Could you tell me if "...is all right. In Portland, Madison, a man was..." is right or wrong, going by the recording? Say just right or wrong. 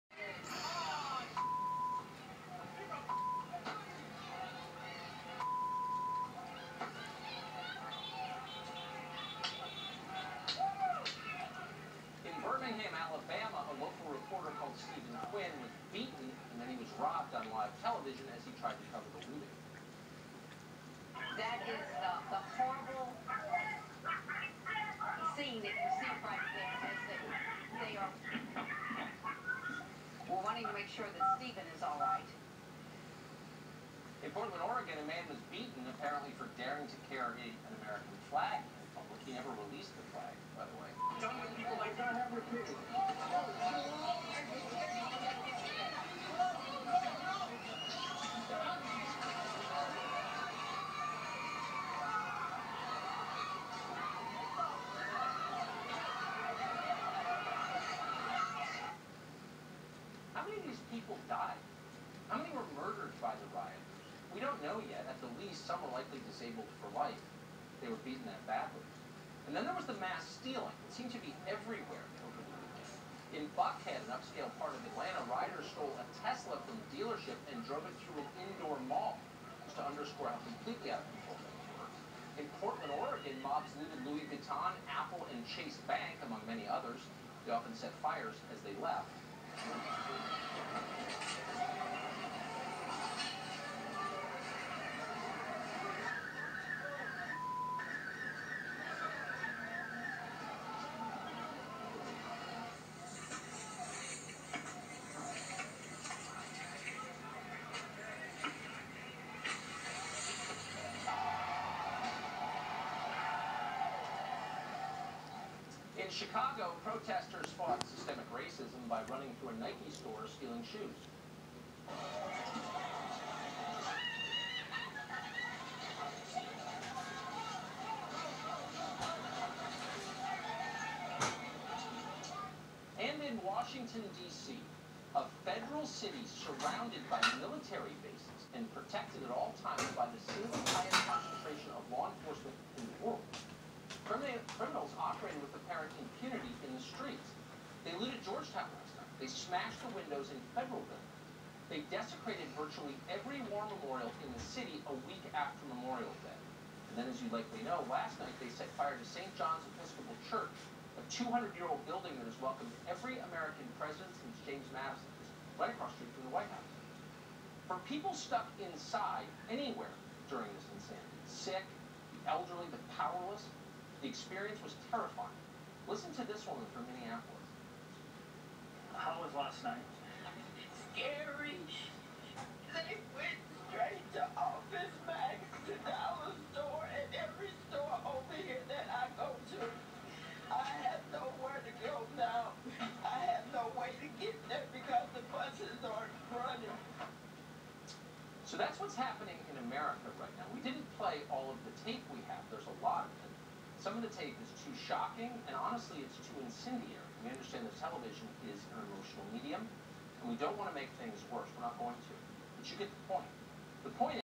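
wrong.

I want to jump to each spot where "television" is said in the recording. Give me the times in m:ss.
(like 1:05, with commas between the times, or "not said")
0:17, 3:27.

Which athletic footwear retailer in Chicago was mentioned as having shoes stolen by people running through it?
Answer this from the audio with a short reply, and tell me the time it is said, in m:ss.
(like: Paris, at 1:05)
Nike, at 1:59.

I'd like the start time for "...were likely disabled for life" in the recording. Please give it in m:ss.
1:05.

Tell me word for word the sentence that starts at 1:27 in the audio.
They often set fires as they left.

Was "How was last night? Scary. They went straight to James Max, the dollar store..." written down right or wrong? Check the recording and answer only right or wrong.
wrong.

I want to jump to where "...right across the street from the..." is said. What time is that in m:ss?
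2:45.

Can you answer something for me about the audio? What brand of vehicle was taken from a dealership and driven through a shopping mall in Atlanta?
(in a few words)
Tesla.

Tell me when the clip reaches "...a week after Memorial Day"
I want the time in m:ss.
2:34.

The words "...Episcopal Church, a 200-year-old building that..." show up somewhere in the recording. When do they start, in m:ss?
2:39.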